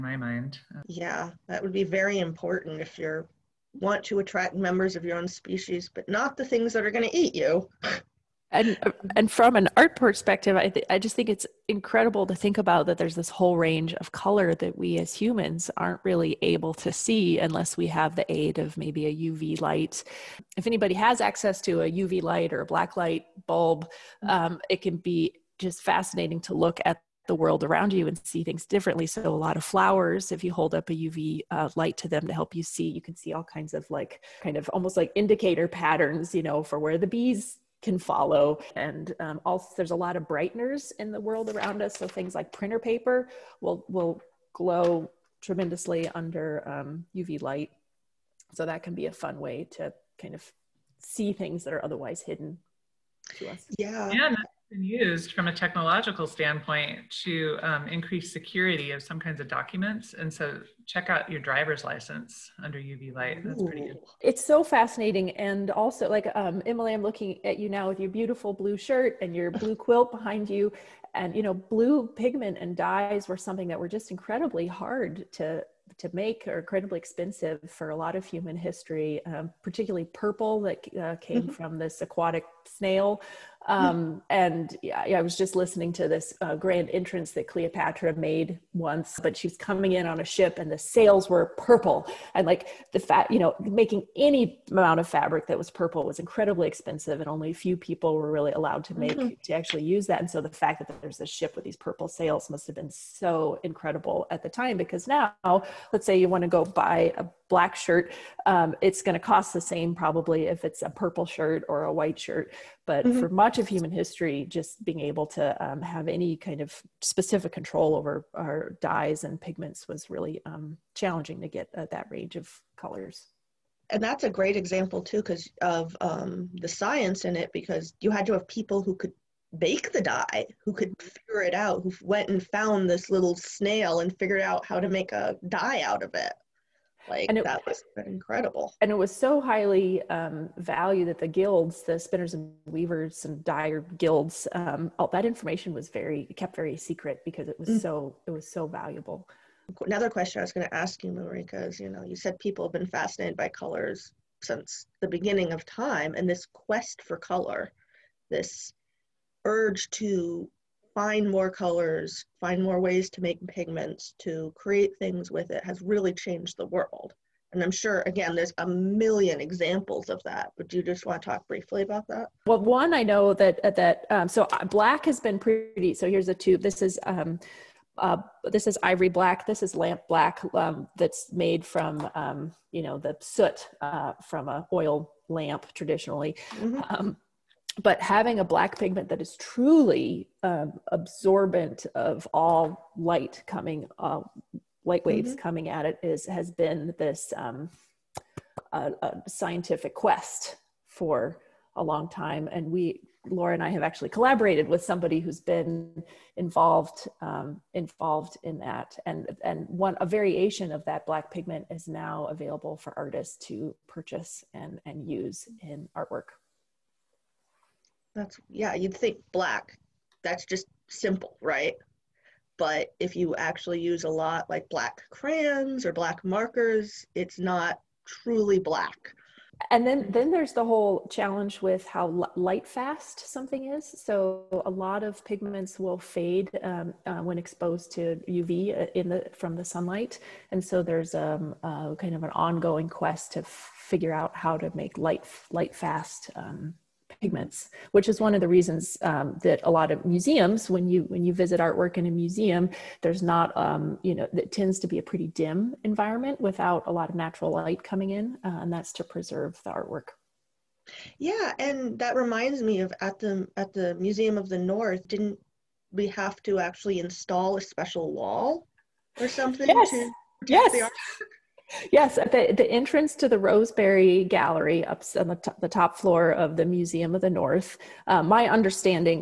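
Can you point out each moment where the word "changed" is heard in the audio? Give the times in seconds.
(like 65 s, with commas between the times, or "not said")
166 s.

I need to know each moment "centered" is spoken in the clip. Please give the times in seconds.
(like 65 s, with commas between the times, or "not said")
not said.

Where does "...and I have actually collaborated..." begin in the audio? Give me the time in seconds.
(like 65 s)
203 s.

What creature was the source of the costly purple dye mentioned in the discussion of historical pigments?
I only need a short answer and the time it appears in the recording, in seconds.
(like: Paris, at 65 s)
aquatic snail, at 82 s.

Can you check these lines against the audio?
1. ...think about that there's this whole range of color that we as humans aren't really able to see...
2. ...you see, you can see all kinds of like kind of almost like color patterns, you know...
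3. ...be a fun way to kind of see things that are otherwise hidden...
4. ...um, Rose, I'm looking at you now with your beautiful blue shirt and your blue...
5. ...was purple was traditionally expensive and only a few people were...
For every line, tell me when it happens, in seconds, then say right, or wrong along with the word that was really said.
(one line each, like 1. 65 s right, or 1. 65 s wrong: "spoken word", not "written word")
1. 12 s right
2. 32 s wrong: "indicator", not "color"
3. 48 s right
4. 66 s wrong: "Emily", not "Rose"
5. 95 s wrong: "incredibly", not "traditionally".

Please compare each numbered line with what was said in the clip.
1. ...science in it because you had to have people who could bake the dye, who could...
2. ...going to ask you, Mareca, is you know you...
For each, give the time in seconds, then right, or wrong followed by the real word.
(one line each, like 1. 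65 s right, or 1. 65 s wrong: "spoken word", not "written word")
1. 126 s right
2. 150 s right.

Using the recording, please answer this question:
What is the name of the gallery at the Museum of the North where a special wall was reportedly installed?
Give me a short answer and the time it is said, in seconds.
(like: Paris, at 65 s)
Rose Berry Gallery, at 273 s.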